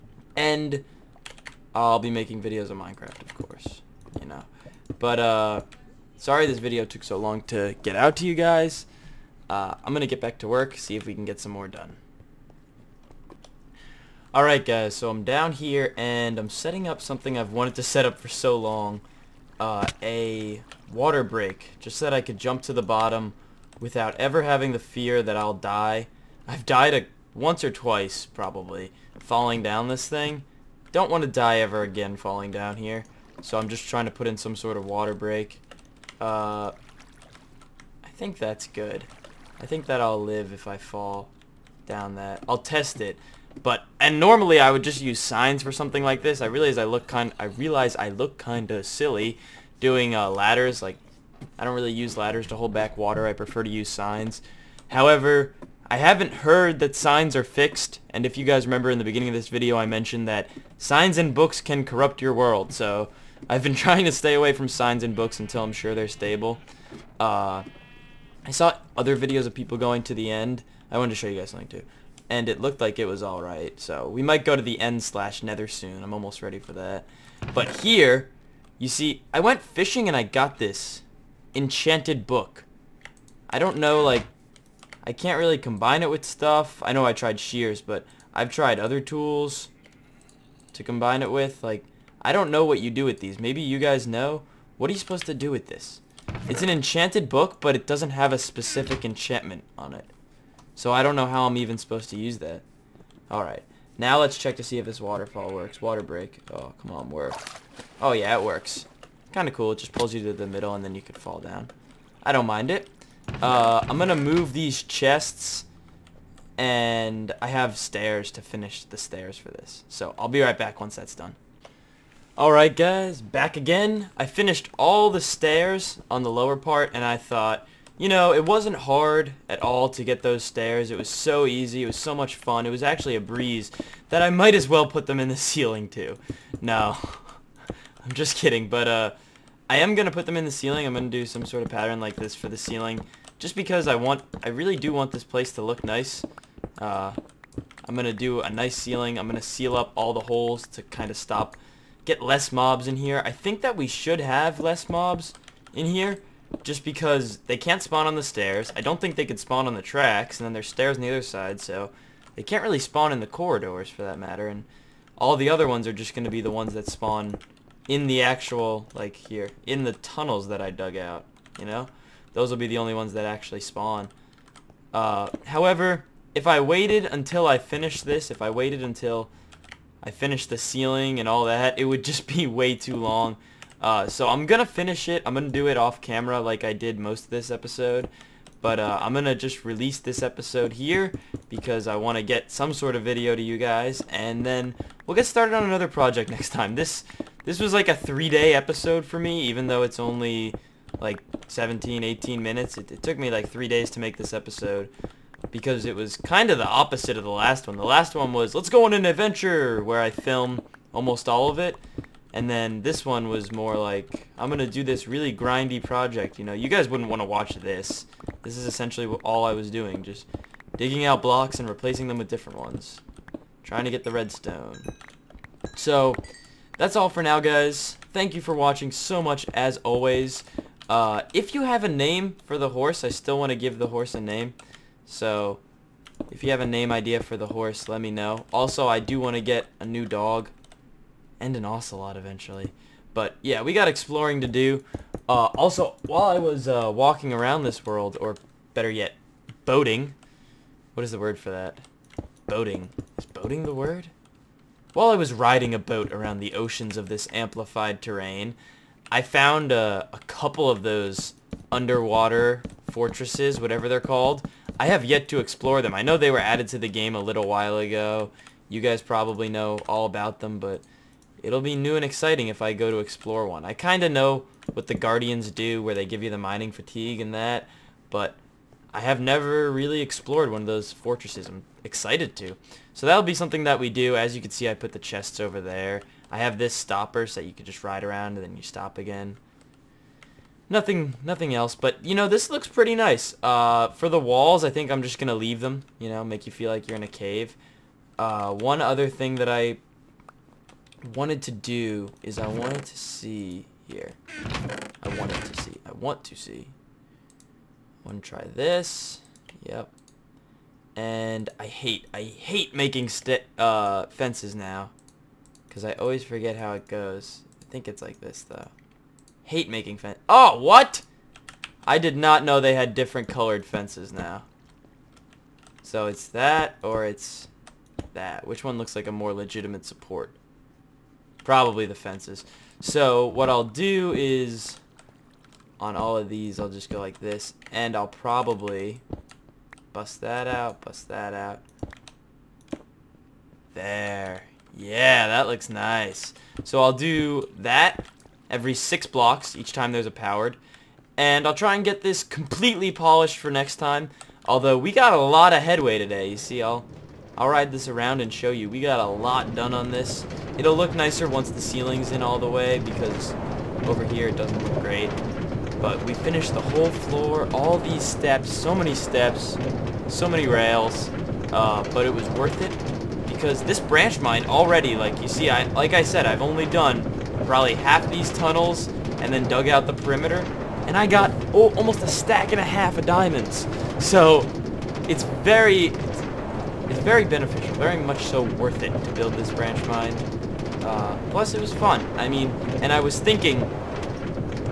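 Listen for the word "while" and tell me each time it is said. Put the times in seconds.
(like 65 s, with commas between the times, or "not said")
246 s, 254 s, 267 s.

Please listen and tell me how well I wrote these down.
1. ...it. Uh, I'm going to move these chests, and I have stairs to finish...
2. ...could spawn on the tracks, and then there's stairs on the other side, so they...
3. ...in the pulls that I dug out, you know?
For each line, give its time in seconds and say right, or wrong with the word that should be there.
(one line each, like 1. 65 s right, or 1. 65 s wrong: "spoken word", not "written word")
1. 112 s right
2. 159 s right
3. 169 s wrong: "tunnels", not "pulls".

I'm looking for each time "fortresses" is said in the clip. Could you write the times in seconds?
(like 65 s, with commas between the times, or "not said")
262 s, 280 s.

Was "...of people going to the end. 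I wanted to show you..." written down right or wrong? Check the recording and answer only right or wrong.
right.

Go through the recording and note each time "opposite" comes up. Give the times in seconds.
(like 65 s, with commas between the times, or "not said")
206 s.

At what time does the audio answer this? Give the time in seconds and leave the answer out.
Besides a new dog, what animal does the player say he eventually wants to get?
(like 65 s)
241 s.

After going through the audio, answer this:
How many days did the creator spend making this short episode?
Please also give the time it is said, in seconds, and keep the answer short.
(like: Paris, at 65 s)
3, at 197 s.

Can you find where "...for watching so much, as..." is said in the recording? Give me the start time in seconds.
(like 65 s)
228 s.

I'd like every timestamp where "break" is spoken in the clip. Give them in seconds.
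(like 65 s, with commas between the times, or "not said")
21 s, 35 s, 106 s.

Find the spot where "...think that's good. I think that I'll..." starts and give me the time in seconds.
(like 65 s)
38 s.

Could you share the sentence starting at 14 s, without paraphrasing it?
Alright guys, so I'm down here and I'm setting up something I've wanted to set up for so long.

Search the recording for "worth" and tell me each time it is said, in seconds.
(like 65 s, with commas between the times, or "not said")
372 s, 388 s.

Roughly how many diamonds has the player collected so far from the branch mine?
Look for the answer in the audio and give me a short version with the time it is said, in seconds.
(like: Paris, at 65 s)
Almost a stack and a half, at 381 s.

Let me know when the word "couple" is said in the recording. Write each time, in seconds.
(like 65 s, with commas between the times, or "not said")
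260 s.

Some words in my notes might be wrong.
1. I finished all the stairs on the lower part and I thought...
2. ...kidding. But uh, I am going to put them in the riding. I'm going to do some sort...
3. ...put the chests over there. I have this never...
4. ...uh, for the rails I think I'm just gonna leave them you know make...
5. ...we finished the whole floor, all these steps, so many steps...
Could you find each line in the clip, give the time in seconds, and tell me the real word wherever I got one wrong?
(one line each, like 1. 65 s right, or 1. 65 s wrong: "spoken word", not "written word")
1. 124 s right
2. 138 s wrong: "ceiling", not "riding"
3. 284 s wrong: "stopper", not "never"
4. 293 s wrong: "walls", not "rails"
5. 366 s right.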